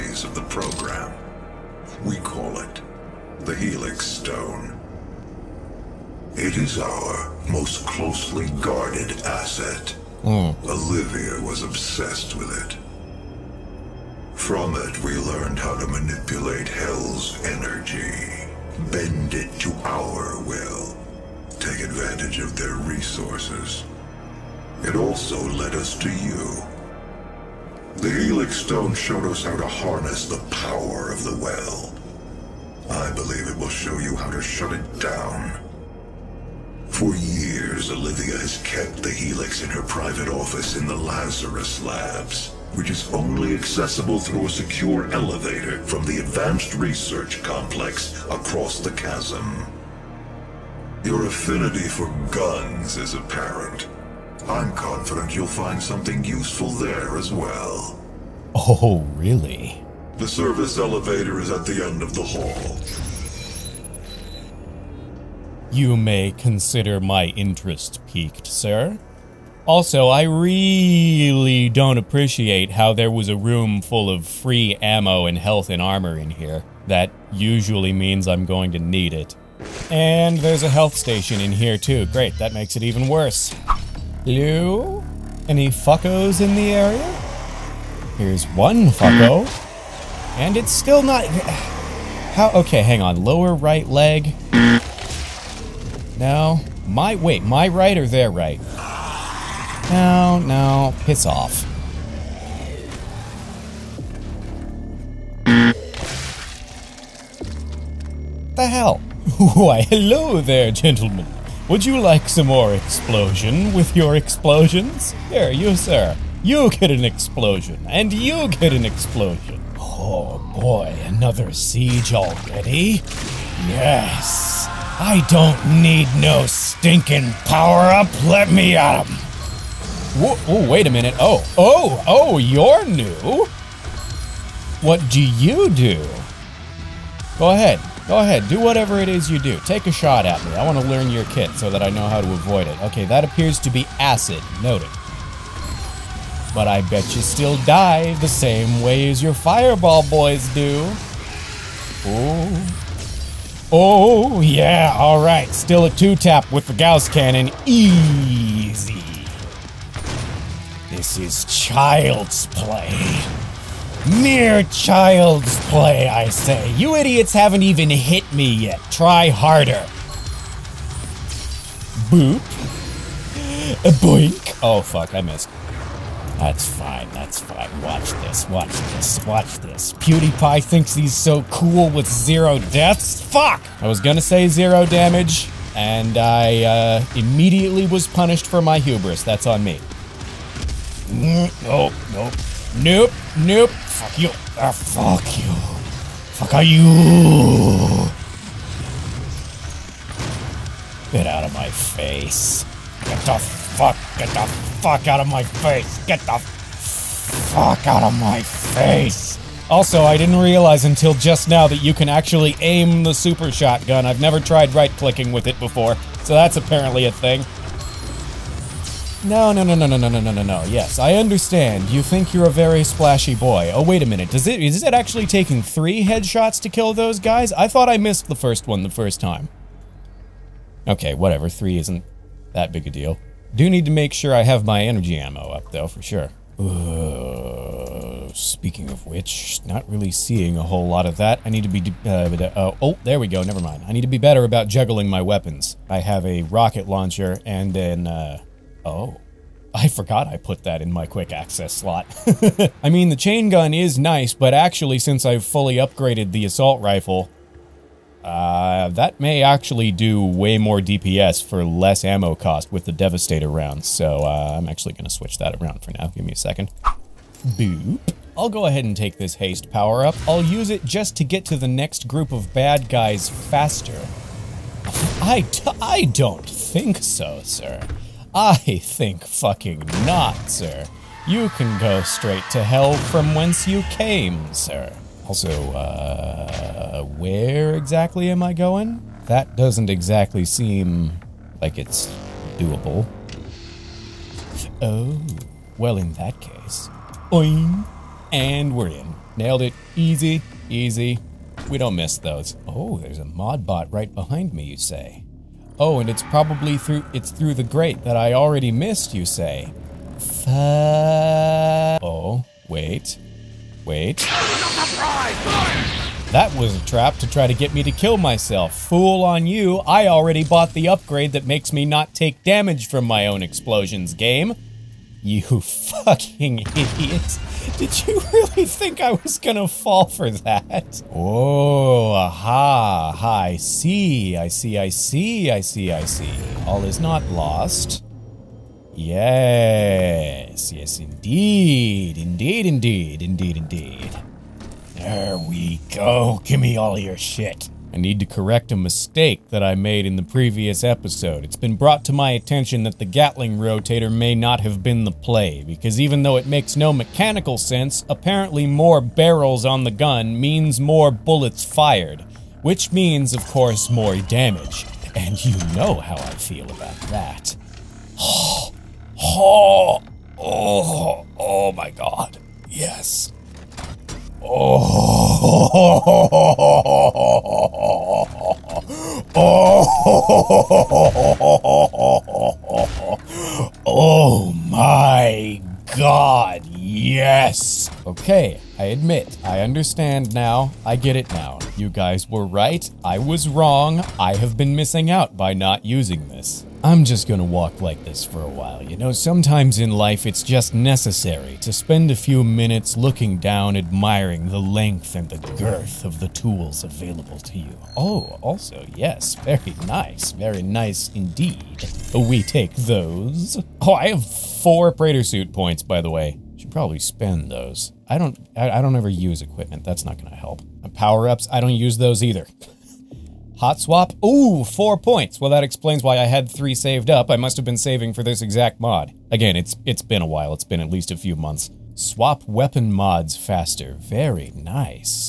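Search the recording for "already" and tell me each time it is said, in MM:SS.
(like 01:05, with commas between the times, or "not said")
02:02, 05:08, 05:20.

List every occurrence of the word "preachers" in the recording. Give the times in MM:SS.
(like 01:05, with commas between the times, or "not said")
not said.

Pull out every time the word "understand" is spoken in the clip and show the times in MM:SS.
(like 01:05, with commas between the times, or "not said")
03:41, 06:29.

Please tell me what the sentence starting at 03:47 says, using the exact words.
I thought I missed the first one the first time.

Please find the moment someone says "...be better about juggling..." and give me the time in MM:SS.
04:04.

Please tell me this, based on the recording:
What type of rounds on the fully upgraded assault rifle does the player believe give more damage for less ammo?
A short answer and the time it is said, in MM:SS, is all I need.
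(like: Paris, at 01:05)
Devastator rounds, at 04:22.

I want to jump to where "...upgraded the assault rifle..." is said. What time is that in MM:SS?
04:15.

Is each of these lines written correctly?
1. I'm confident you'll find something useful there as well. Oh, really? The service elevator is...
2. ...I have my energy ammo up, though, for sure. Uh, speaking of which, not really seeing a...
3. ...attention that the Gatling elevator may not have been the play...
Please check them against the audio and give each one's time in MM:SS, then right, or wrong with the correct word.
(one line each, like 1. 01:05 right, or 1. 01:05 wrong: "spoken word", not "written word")
1. 00:54 right
2. 03:54 right
3. 05:52 wrong: "rotator", not "elevator".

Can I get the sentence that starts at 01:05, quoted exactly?
You may consider my interest piqued, sir.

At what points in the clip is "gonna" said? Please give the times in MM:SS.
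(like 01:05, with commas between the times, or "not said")
03:03, 05:29, 06:37.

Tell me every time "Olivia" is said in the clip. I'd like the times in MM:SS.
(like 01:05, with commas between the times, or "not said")
00:10, 00:37.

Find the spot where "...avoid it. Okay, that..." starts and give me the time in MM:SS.
02:22.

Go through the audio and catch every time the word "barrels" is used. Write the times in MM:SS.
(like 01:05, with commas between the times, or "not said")
05:58.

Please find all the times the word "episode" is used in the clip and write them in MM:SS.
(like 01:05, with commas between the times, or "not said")
05:50.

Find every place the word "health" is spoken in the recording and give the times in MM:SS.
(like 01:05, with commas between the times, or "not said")
01:15, 01:20.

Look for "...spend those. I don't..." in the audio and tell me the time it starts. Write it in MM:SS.
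06:56.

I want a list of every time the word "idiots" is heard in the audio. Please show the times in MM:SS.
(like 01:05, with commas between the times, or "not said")
02:46, 05:26.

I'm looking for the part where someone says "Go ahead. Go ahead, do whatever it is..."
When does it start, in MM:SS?
02:17.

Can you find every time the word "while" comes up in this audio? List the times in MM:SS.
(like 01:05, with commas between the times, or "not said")
06:38, 07:10.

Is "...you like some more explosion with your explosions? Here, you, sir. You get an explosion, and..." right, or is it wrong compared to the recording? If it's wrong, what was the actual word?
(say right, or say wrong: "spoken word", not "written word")
right.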